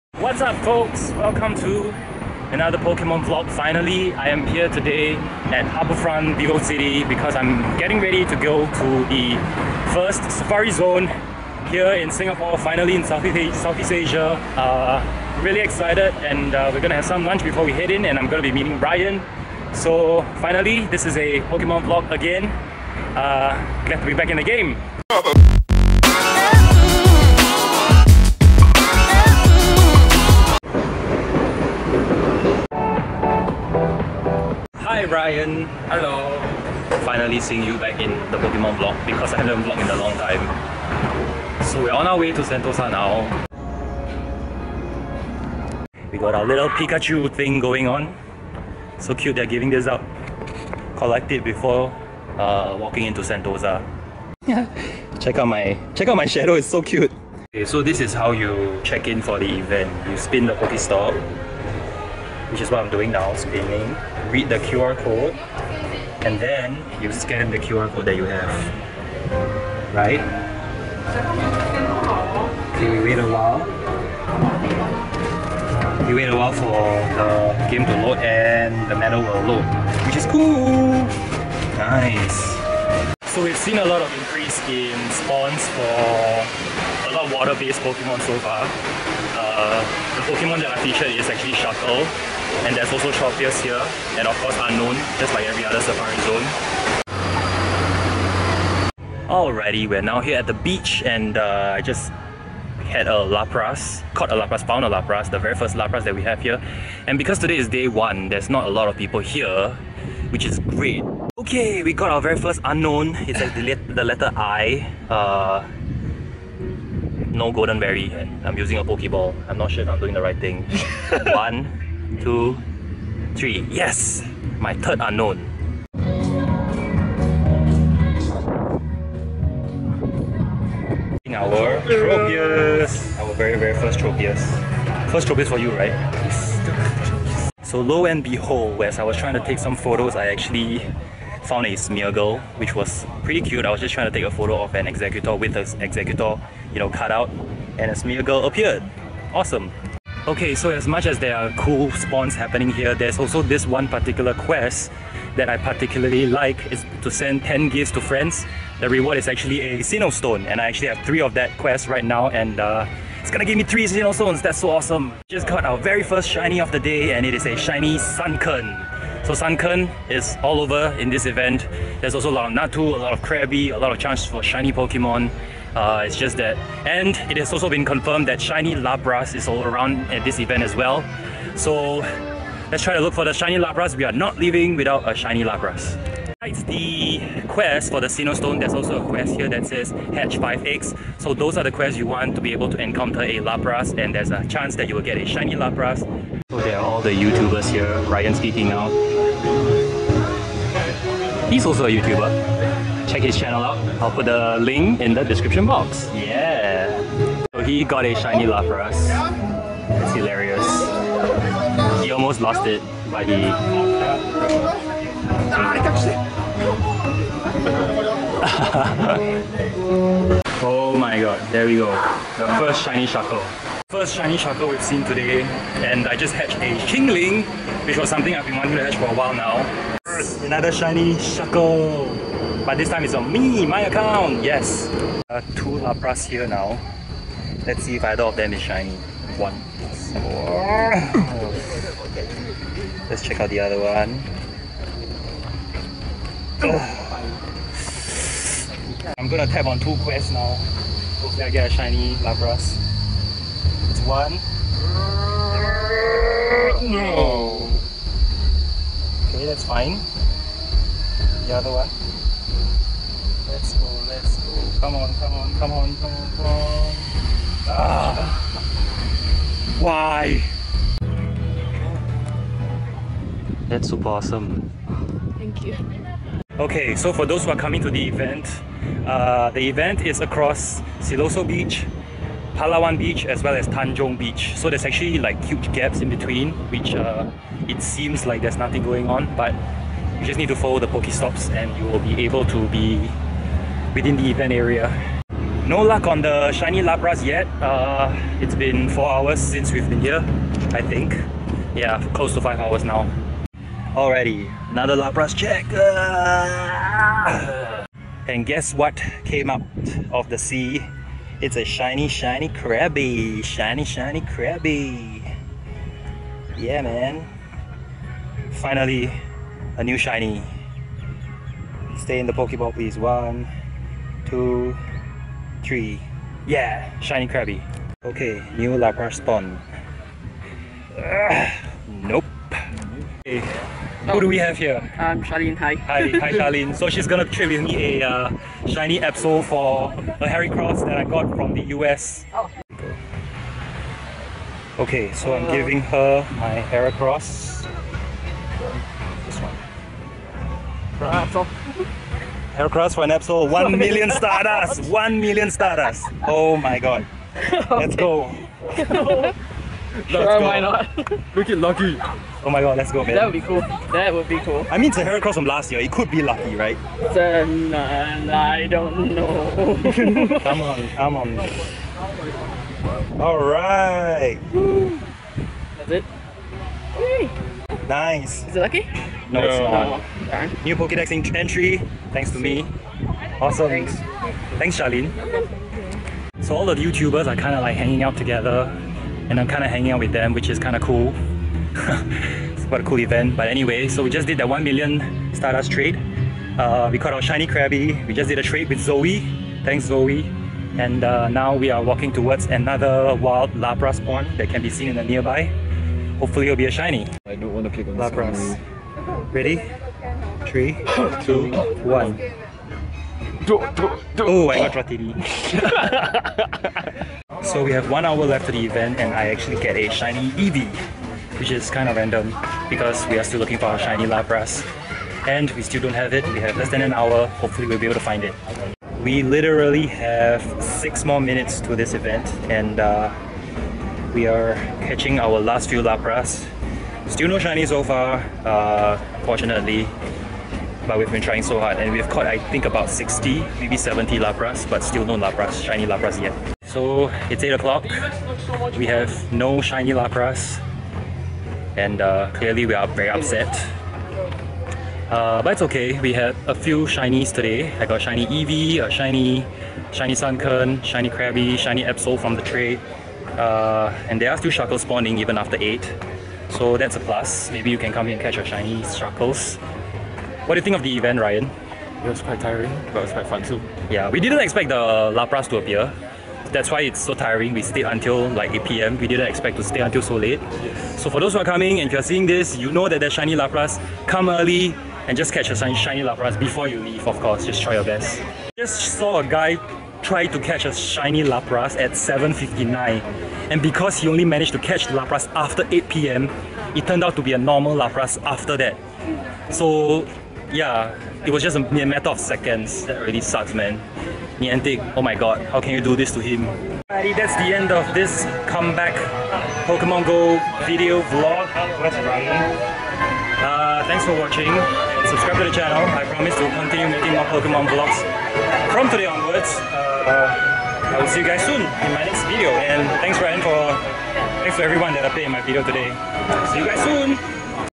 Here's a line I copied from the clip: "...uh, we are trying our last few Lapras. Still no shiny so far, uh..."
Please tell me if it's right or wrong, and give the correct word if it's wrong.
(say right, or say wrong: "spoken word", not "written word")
wrong: "catching", not "trying".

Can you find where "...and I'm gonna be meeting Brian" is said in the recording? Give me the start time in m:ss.
0:18.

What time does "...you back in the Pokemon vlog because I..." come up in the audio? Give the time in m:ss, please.
0:37.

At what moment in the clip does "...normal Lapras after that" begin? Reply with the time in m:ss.
8:17.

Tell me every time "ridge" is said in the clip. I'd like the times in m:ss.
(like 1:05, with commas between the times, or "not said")
not said.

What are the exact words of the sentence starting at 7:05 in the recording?
And we still don't have it, we have less than an hour, hopefully we'll be able to find it.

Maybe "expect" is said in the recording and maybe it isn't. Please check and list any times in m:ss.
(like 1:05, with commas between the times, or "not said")
7:54, 7:59.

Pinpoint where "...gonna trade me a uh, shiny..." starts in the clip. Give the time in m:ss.
5:37.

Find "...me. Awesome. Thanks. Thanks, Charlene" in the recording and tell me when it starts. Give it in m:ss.
6:22.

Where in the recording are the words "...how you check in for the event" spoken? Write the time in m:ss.
0:58.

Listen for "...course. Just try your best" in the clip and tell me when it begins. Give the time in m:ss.
8:07.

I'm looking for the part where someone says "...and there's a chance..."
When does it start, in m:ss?
3:14.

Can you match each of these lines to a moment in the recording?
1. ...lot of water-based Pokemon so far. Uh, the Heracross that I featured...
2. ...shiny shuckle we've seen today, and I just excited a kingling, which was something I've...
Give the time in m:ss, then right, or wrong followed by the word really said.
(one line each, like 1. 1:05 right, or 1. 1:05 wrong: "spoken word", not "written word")
1. 1:27 wrong: "Pokemon", not "Heracross"
2. 3:44 wrong: "hatched", not "excited".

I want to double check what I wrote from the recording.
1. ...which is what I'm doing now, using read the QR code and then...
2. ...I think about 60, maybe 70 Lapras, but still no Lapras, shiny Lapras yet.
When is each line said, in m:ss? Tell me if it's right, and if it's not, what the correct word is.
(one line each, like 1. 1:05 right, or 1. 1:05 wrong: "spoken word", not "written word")
1. 1:02 wrong: "spinning", not "using"
2. 7:22 right.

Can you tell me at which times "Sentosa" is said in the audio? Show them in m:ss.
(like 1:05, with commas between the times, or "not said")
0:42, 0:53.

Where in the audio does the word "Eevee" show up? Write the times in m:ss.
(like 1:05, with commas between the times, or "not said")
7:00, 7:38.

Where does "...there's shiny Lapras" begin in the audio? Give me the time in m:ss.
8:02.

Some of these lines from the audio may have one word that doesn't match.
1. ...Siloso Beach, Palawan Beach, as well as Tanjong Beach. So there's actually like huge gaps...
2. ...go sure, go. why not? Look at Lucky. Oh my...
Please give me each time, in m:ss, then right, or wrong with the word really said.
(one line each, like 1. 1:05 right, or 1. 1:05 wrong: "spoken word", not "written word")
1. 4:40 right
2. 5:57 right.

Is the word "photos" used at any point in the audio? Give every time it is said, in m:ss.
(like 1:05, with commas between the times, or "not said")
2:19, 2:24.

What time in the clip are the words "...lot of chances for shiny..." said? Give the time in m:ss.
2:53.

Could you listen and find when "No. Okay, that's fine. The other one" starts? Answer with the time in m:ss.
4:16.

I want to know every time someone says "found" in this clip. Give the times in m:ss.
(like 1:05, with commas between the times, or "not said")
1:44, 2:21.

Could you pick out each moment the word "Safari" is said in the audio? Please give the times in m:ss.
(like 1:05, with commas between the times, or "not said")
0:10, 1:35.